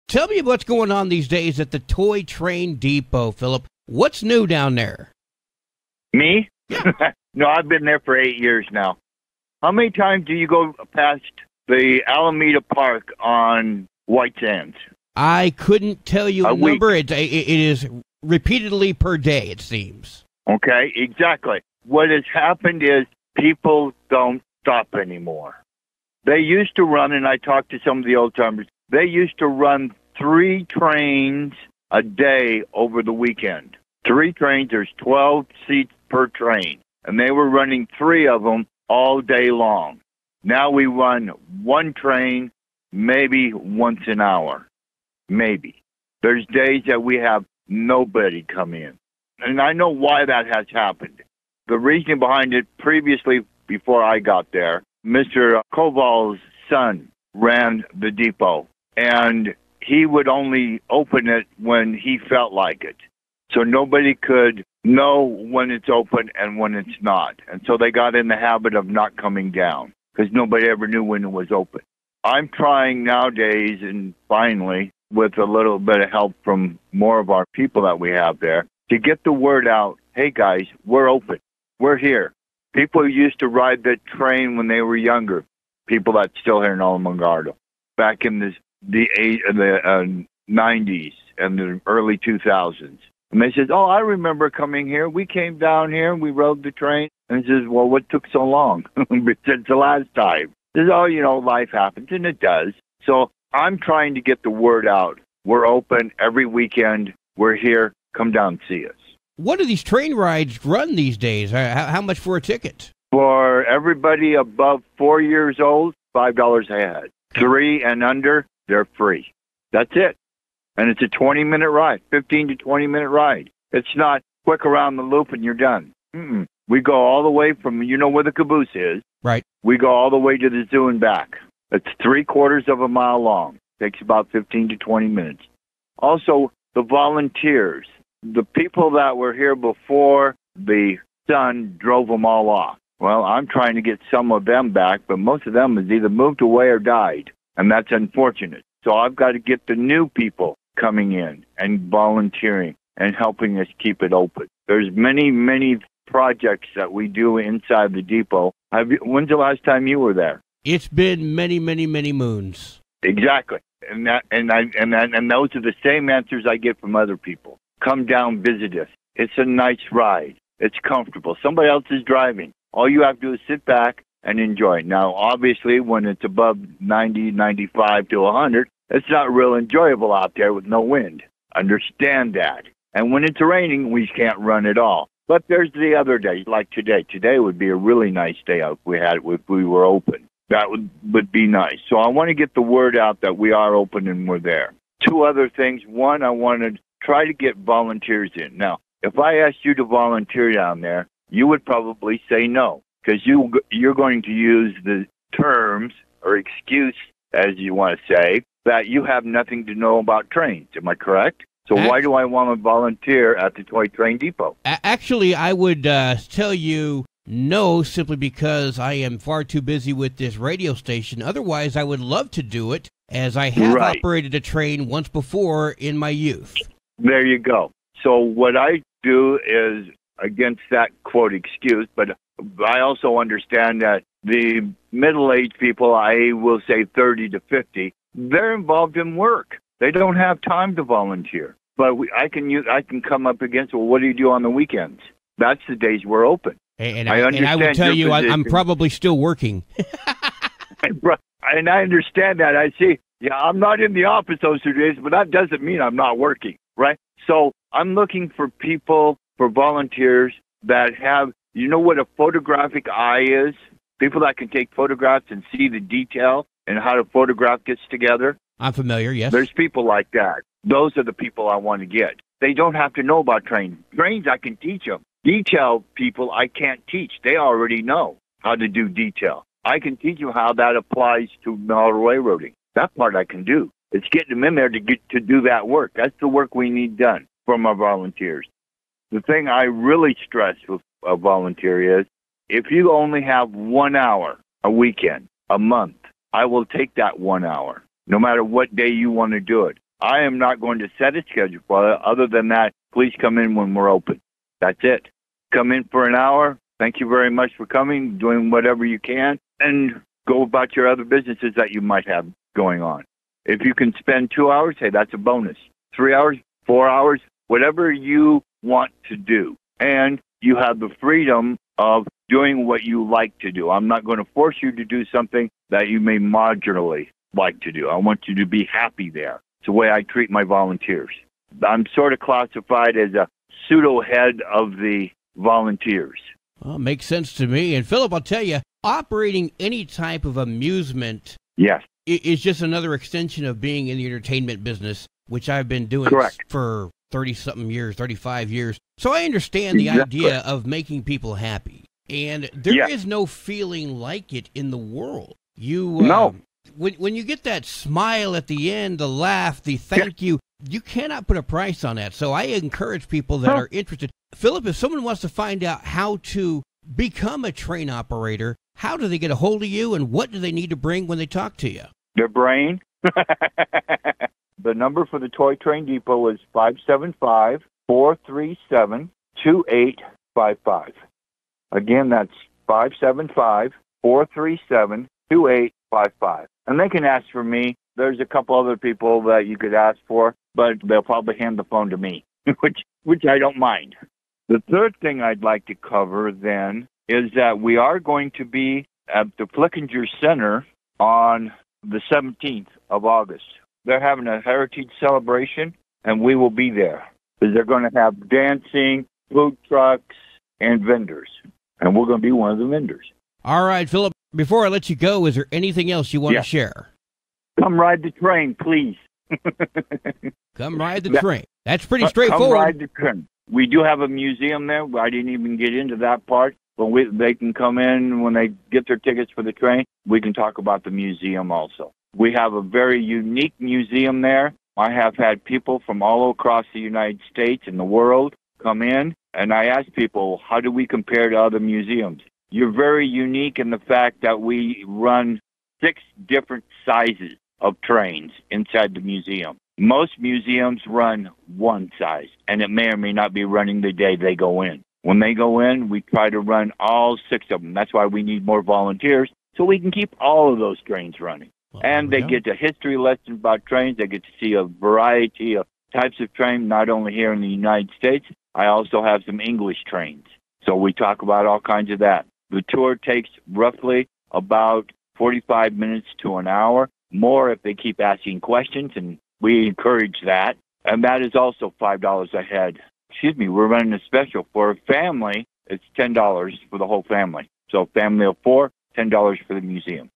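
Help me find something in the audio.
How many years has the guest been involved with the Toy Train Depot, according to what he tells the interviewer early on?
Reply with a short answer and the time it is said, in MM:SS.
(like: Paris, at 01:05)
8 years, at 00:08.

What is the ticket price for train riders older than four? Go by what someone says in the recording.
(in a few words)
$5.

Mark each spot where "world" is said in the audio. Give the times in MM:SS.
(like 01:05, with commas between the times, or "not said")
05:54, 07:17.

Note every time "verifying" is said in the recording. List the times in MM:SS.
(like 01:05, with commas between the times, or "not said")
not said.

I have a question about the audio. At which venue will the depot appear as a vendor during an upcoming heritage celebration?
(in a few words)
Flickinger Center.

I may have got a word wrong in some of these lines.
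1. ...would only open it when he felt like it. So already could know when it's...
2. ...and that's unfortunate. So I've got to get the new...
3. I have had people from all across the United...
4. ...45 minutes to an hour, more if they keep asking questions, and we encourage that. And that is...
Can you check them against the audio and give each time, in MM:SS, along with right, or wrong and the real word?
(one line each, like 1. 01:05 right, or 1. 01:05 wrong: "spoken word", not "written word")
1. 01:00 wrong: "nobody", not "already"
2. 02:27 right
3. 07:14 right
4. 07:55 right.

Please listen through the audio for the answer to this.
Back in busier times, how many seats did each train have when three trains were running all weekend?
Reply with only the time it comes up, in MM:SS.
00:34.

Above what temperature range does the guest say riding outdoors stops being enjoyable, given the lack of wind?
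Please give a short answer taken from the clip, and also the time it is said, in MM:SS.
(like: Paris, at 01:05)
90 to 100, at 02:56.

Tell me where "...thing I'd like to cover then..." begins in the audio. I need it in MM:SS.
06:35.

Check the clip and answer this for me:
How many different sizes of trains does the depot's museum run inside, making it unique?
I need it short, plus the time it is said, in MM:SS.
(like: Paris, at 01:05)
6, at 07:25.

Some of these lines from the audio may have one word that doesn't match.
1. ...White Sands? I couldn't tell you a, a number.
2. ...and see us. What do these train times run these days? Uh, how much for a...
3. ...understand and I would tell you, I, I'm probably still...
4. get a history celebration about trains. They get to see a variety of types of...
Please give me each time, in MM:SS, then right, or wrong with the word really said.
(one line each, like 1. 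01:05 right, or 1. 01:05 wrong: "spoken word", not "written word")
1. 00:14 right
2. 01:48 wrong: "rides", not "times"
3. 04:07 right
4. 07:42 wrong: "lesson", not "celebration".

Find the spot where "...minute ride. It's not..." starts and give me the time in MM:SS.
02:02.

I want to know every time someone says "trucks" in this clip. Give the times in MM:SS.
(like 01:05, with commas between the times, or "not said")
06:49.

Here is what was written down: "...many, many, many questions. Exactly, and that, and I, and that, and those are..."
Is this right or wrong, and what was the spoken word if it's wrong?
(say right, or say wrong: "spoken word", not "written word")
wrong: "moons", not "questions".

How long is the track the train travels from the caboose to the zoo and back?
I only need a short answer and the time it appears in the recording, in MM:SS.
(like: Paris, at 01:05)
Three quarters of a mile, at 02:12.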